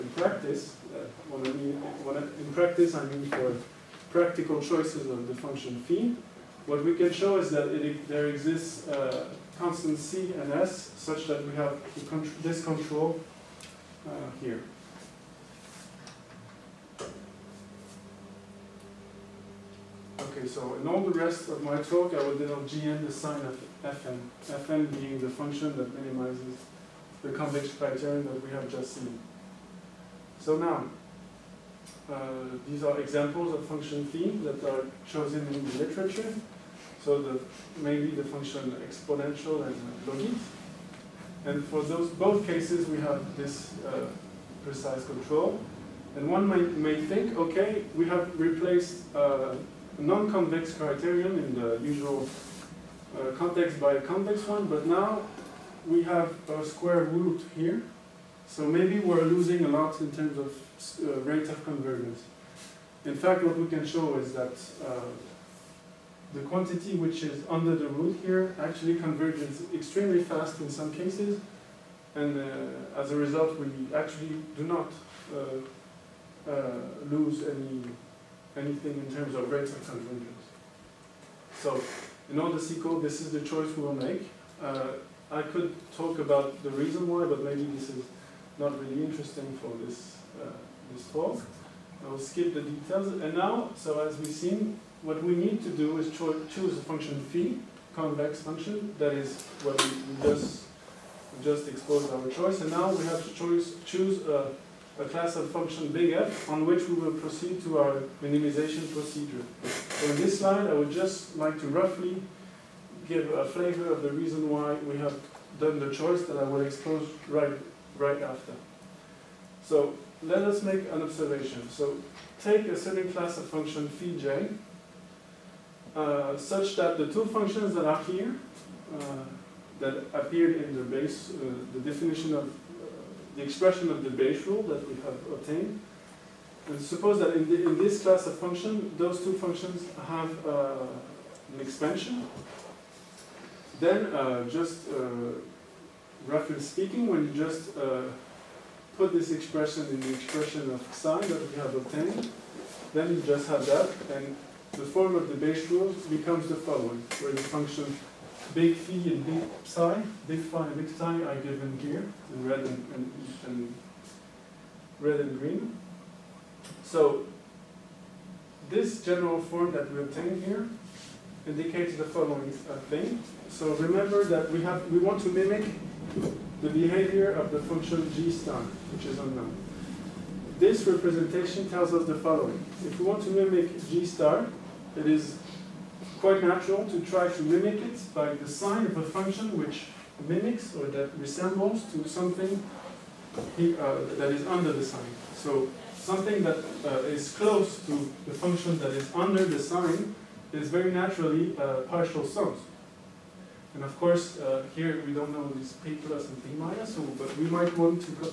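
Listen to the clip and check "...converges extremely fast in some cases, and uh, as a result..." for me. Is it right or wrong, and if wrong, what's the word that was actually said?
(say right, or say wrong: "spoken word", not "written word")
right.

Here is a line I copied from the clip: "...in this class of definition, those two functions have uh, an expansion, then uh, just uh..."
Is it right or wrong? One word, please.
wrong.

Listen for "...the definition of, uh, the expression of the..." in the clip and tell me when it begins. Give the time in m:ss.
2:11.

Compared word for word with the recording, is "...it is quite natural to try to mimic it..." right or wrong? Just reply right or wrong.
right.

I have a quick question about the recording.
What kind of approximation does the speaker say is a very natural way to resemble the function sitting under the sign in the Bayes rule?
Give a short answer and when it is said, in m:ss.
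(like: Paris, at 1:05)
partial sums, at 3:21.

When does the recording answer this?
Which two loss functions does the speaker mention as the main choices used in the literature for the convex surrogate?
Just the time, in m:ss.
0:38.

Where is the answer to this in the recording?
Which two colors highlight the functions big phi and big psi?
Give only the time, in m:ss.
2:44.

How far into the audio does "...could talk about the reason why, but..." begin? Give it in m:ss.
1:25.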